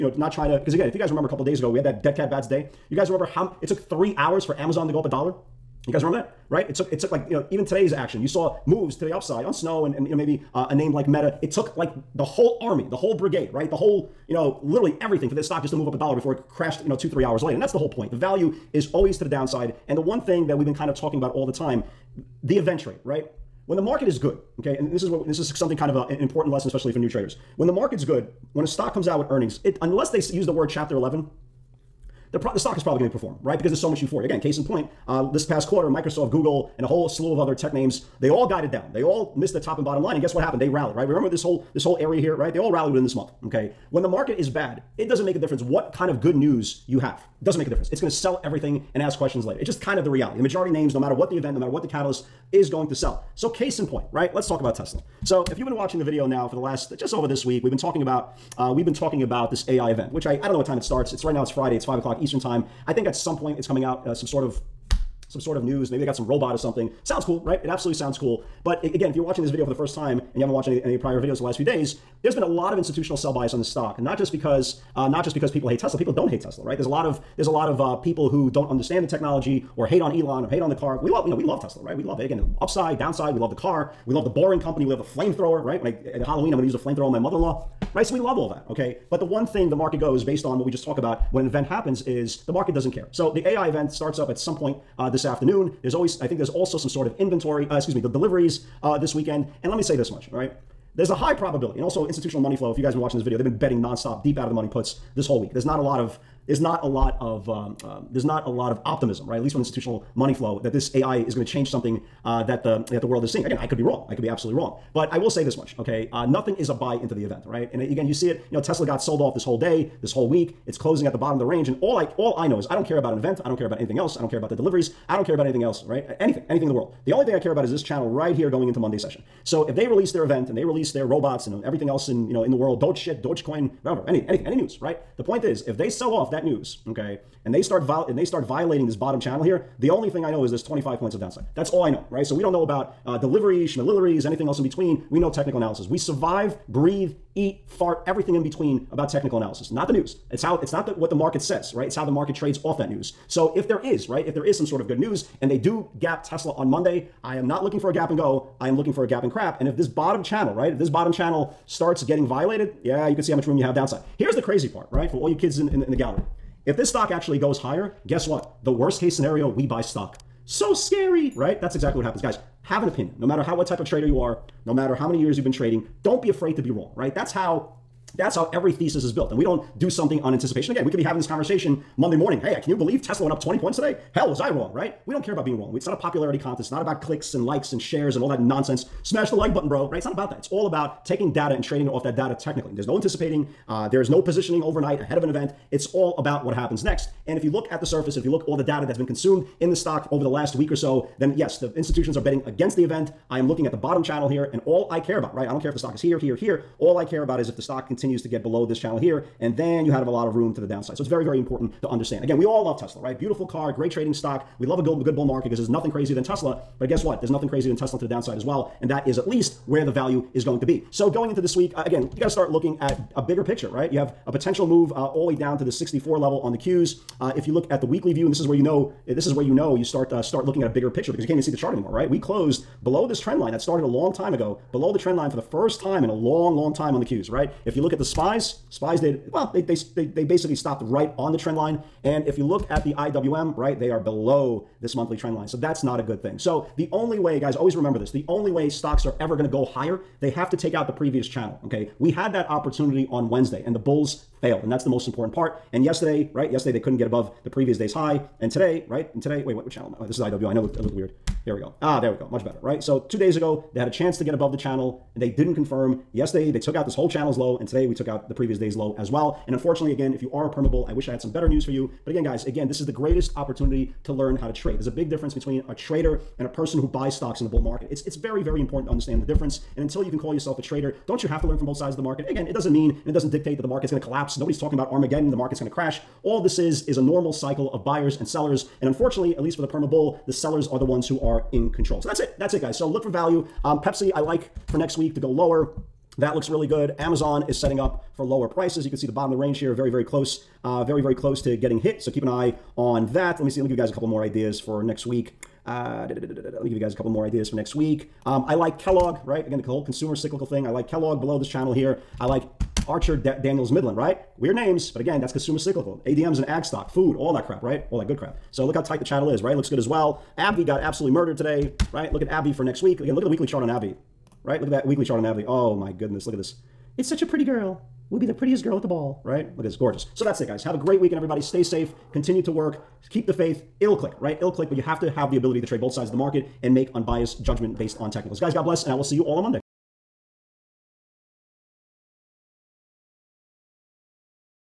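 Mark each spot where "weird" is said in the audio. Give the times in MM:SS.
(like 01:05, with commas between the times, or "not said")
04:20, 05:14.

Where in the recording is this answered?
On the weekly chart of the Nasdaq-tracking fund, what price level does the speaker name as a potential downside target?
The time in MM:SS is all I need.
03:45.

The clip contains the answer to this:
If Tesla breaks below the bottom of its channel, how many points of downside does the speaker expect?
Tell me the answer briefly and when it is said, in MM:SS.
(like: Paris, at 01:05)
25, at 02:20.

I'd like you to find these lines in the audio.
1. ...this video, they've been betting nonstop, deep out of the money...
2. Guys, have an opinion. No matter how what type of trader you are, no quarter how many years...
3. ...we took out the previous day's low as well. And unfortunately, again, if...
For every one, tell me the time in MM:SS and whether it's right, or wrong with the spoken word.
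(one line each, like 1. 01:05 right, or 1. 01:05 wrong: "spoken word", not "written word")
1. 01:43 right
2. 02:52 wrong: "matter", not "quarter"
3. 04:27 right.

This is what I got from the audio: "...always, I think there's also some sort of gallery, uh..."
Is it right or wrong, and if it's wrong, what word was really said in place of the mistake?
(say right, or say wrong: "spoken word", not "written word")
wrong: "inventory", not "gallery".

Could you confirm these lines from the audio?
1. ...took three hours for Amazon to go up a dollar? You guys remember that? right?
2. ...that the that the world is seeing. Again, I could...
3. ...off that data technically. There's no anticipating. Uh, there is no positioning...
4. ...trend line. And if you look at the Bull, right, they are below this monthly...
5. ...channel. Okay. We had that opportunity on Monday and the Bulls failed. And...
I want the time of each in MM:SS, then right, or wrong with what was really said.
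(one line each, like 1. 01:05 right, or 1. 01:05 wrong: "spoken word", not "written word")
1. 00:03 right
2. 01:52 right
3. 03:11 right
4. 04:01 wrong: "IWM", not "Bull"
5. 04:11 wrong: "Wednesday", not "Monday".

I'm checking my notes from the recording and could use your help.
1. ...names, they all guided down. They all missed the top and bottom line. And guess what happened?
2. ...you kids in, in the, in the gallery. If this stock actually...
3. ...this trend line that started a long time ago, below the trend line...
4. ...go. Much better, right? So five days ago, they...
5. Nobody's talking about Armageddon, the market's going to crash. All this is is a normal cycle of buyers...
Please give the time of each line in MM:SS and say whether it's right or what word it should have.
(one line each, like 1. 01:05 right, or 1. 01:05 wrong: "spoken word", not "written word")
1. 00:37 right
2. 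02:45 right
3. 03:53 right
4. 04:22 wrong: "two", not "five"
5. 04:44 right.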